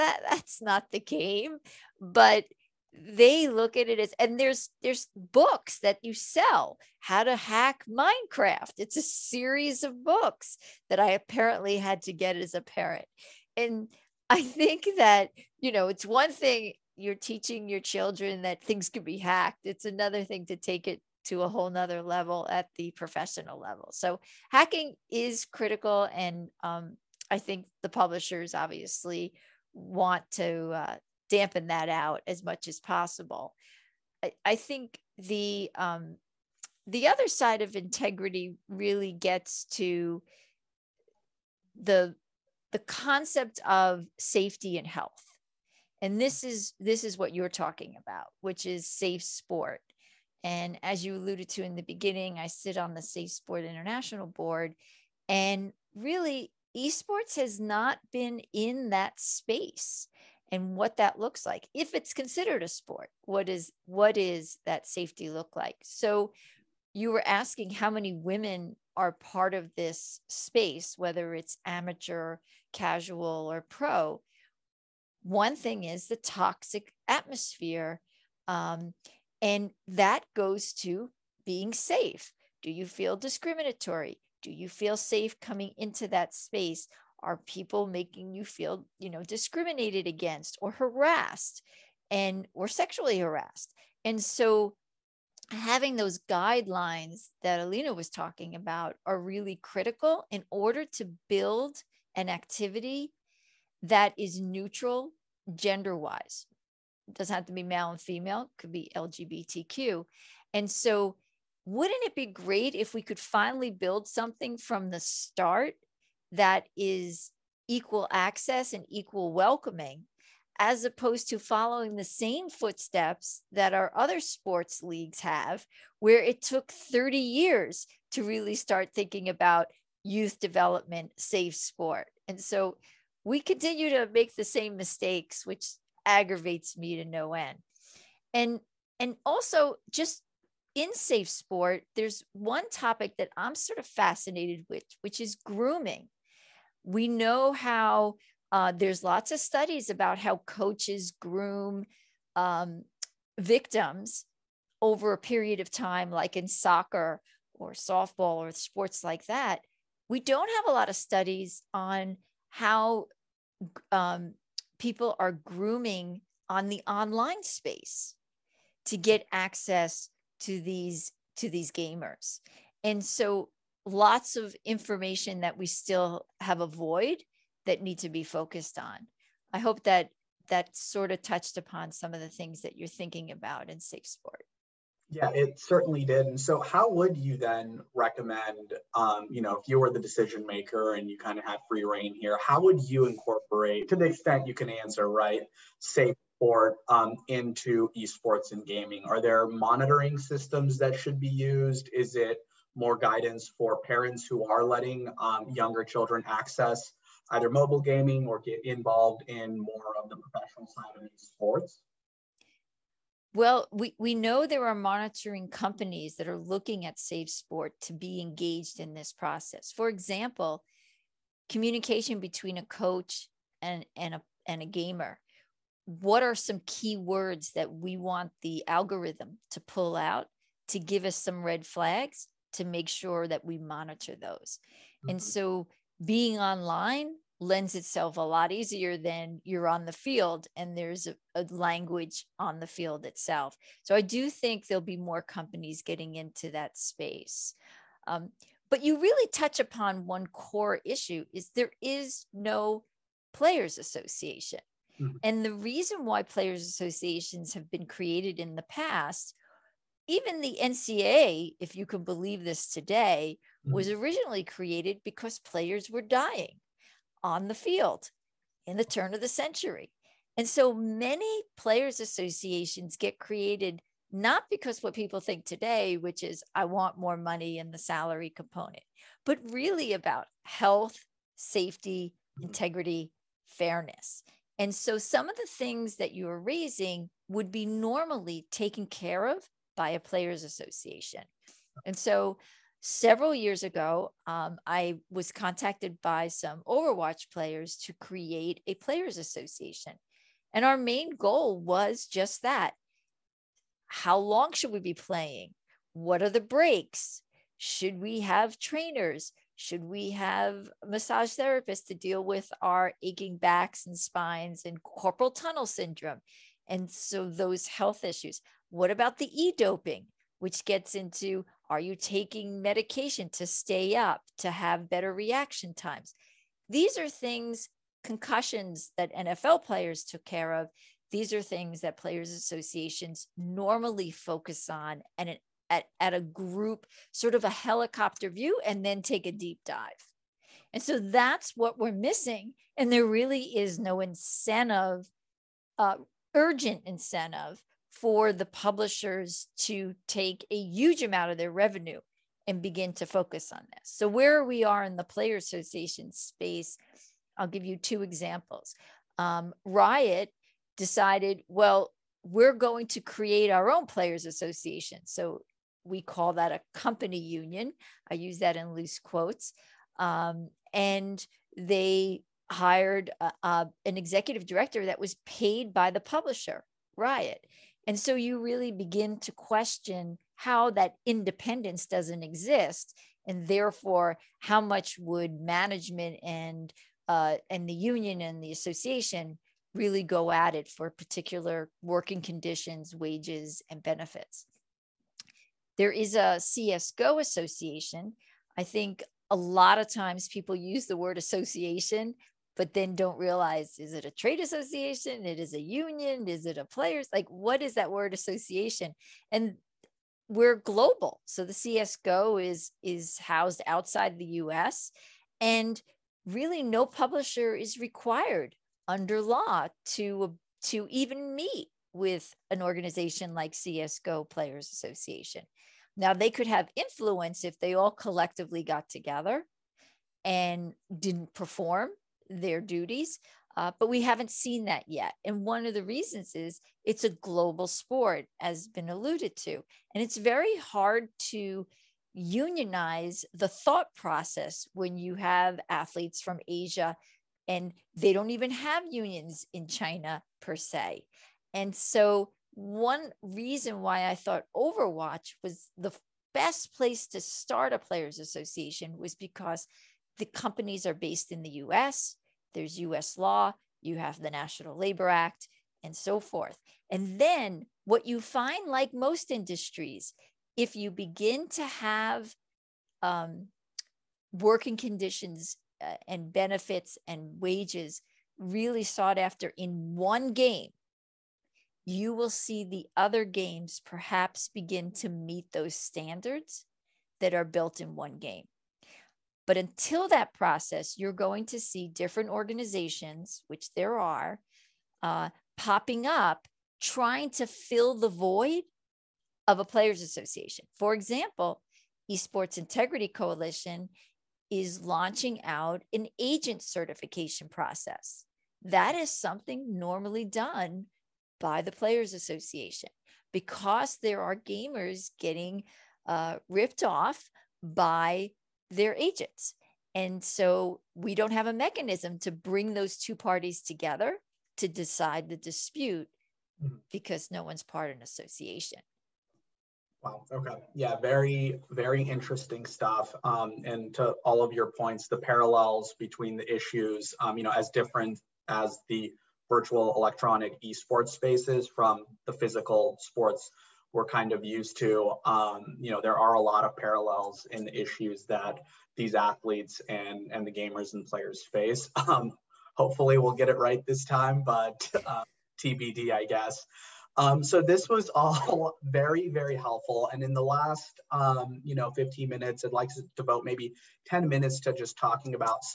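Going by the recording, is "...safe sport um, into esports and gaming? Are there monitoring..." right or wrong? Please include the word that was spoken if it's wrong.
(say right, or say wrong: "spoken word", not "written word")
right.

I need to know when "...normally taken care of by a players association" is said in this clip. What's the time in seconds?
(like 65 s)
287 s.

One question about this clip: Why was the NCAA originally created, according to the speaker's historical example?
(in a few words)
Players were dying on the field.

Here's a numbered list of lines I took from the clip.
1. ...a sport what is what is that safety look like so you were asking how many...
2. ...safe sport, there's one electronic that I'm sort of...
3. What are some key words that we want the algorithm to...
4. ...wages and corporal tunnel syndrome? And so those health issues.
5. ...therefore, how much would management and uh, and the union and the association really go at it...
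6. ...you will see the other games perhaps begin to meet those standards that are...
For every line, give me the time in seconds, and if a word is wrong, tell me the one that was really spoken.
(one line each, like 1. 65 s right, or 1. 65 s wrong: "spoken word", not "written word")
1. 62 s right
2. 140 s wrong: "topic", not "electronic"
3. 225 s right
4. 313 s wrong: "spines", not "wages"
5. 383 s right
6. 481 s right.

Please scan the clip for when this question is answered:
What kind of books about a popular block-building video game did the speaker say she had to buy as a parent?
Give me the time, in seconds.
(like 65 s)
6 s.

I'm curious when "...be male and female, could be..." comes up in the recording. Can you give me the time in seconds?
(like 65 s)
107 s.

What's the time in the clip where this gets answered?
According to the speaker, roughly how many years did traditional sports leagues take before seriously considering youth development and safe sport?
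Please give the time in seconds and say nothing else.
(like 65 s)
126 s.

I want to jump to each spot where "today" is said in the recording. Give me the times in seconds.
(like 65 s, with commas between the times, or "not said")
262 s, 275 s.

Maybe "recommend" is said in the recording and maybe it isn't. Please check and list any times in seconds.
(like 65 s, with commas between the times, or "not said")
187 s.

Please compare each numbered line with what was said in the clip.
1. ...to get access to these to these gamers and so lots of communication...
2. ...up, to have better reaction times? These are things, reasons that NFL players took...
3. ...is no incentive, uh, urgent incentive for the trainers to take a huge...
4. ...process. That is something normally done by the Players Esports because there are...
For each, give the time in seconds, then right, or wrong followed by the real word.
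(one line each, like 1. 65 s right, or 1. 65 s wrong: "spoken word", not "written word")
1. 168 s wrong: "information", not "communication"
2. 323 s wrong: "concussions", not "reasons"
3. 343 s wrong: "publishers", not "trainers"
4. 507 s wrong: "Association", not "Esports".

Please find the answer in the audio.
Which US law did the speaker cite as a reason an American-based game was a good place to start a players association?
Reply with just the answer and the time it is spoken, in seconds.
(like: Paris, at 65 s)
National Labor Act, at 464 s.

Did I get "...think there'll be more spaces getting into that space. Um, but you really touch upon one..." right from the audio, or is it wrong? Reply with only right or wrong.
wrong.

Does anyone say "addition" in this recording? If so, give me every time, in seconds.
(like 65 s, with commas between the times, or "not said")
not said.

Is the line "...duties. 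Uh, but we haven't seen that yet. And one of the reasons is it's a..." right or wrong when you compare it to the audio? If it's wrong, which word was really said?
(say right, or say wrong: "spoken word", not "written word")
right.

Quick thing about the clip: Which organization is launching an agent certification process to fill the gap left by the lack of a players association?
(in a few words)
Esports Integrity Coalition.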